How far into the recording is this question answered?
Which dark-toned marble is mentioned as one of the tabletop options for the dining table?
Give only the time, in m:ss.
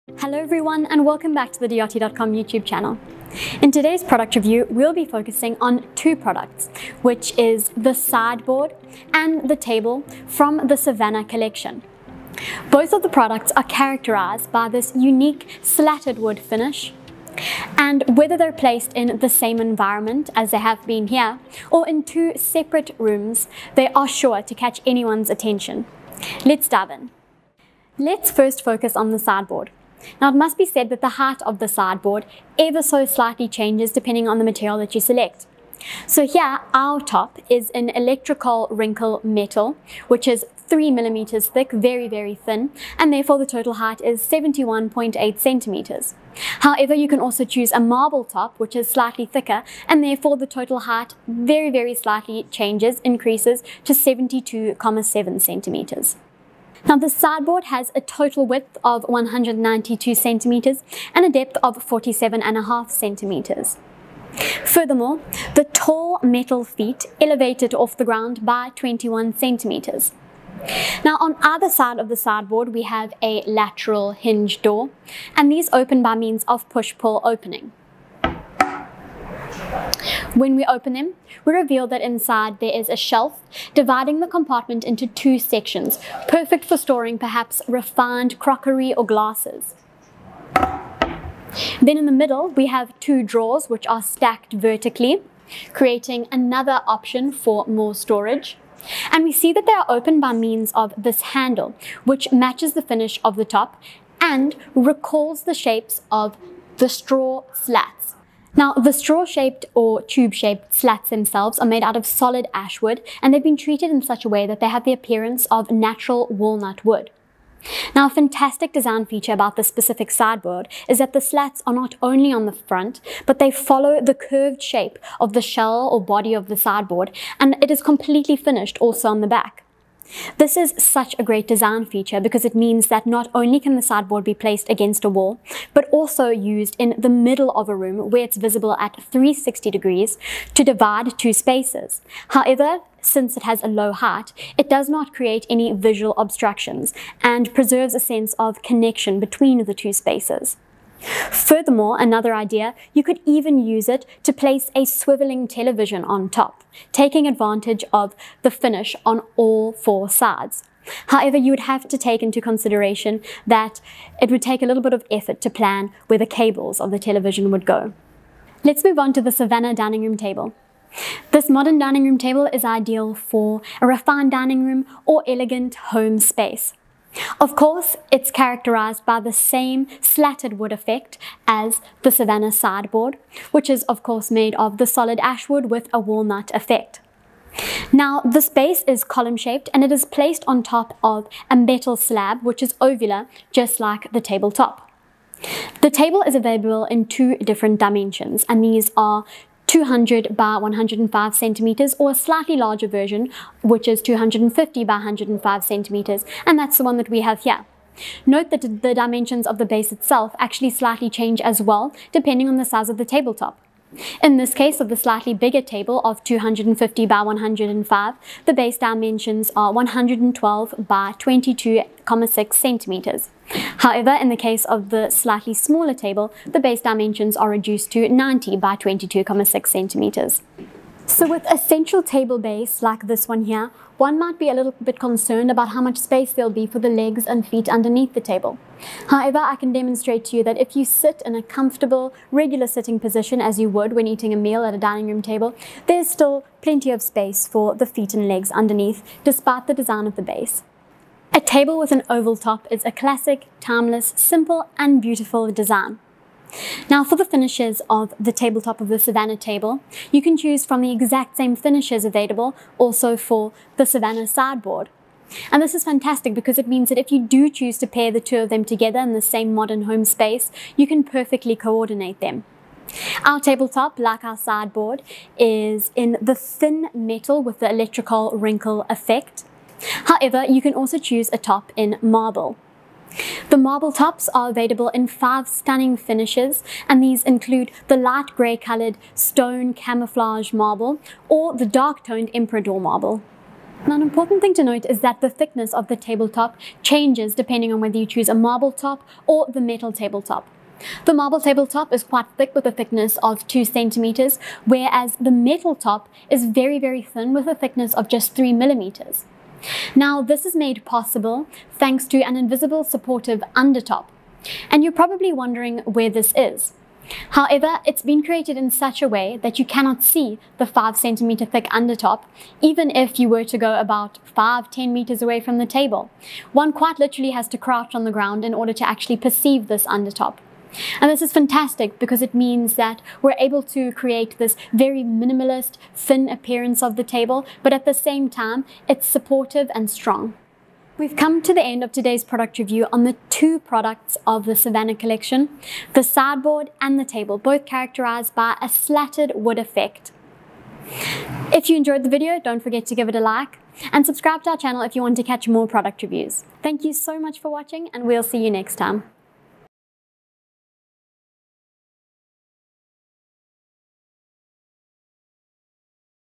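4:52.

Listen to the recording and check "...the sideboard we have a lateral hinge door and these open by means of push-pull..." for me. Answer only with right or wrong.
right.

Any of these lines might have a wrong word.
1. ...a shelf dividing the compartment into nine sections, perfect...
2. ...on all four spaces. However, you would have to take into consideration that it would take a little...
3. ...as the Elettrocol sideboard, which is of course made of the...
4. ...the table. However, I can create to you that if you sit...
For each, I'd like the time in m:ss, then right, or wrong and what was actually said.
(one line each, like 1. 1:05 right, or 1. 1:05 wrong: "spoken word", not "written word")
1. 1:22 wrong: "two", not "nine"
2. 2:39 wrong: "sides", not "spaces"
3. 3:01 wrong: "Savannah", not "Elettrocol"
4. 3:58 wrong: "demonstrate", not "create".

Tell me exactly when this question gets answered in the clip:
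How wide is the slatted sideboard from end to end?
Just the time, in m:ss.
0:59.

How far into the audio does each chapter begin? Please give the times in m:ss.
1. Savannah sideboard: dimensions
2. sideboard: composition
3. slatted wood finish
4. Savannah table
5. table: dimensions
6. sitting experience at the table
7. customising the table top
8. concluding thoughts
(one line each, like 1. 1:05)
1. 0:27
2. 1:10
3. 1:47
4. 2:48
5. 3:16
6. 3:50
7. 4:11
8. 4:54.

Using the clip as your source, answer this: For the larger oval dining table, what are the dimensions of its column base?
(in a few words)
112 by 22.6 centimeters.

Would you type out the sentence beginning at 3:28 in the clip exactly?
Note that the dimensions of the base itself actually slightly change as well depending on the size of the tabletop.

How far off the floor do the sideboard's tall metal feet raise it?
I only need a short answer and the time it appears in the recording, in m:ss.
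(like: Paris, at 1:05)
21 centimeters, at 1:08.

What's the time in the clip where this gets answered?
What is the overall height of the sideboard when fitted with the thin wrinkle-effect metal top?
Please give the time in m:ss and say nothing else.
0:44.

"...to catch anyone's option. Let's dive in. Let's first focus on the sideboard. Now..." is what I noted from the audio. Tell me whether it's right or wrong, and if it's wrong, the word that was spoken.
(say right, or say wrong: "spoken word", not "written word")
wrong: "attention", not "option".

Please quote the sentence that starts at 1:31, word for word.
Then in the middle, we have two drawers which are stacked vertically, creating another option for more storage.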